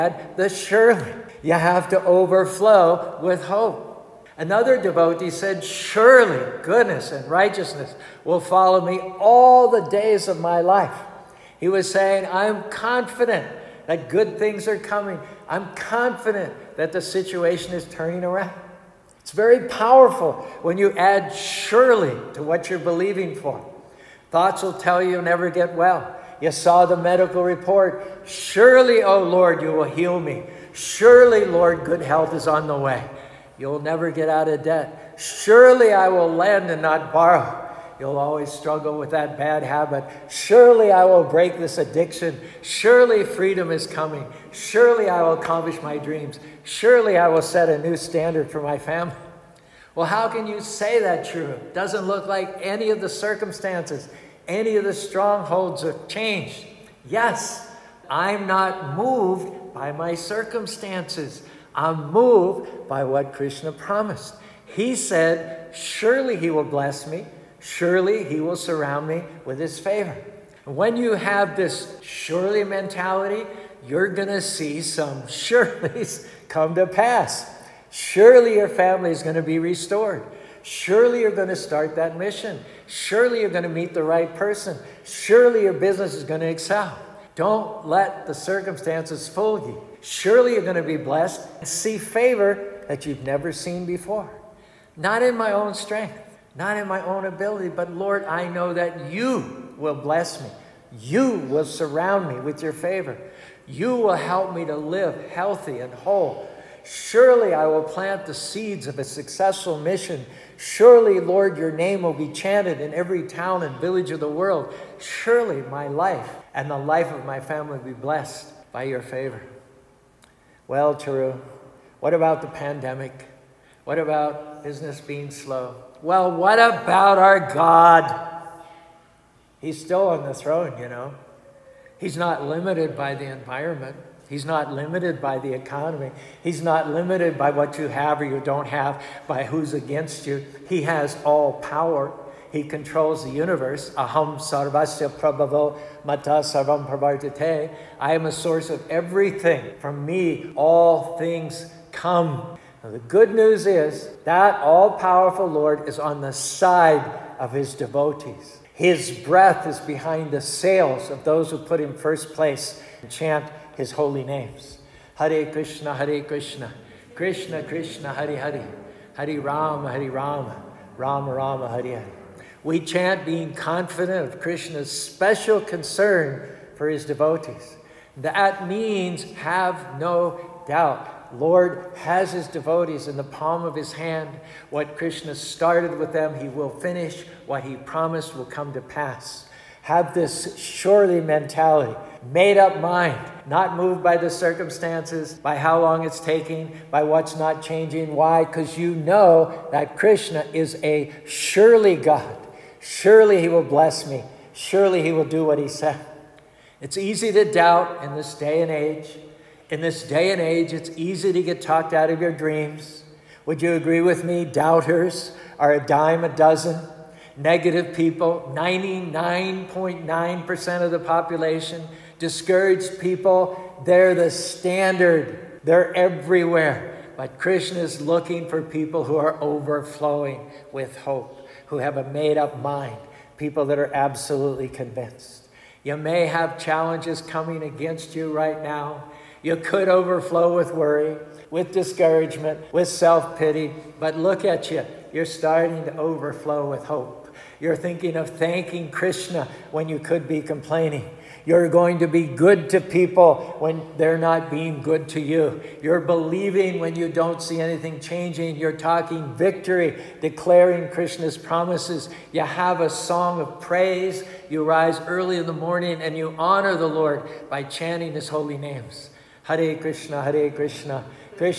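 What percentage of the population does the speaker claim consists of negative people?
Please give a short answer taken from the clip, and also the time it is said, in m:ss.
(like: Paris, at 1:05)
99.9%, at 3:38.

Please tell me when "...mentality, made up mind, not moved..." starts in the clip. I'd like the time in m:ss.
3:11.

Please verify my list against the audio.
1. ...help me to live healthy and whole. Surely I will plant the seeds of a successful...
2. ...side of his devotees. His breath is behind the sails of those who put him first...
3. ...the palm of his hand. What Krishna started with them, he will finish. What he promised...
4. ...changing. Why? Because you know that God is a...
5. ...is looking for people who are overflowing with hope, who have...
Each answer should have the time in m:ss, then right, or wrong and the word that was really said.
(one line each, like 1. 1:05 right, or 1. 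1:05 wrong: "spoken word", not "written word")
1. 1:44 right
2. 2:36 right
3. 3:03 right
4. 3:17 wrong: "Krishna", not "God"
5. 3:47 right.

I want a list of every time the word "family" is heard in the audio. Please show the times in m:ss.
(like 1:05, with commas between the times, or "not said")
0:48, 1:18, 1:57.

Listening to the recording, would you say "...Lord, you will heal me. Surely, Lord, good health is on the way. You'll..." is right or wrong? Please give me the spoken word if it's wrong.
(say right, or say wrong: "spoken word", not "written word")
right.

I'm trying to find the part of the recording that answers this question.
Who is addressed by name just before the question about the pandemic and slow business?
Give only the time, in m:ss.
2:00.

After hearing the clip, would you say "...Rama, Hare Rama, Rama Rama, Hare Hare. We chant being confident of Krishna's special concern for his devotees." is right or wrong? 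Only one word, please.
right.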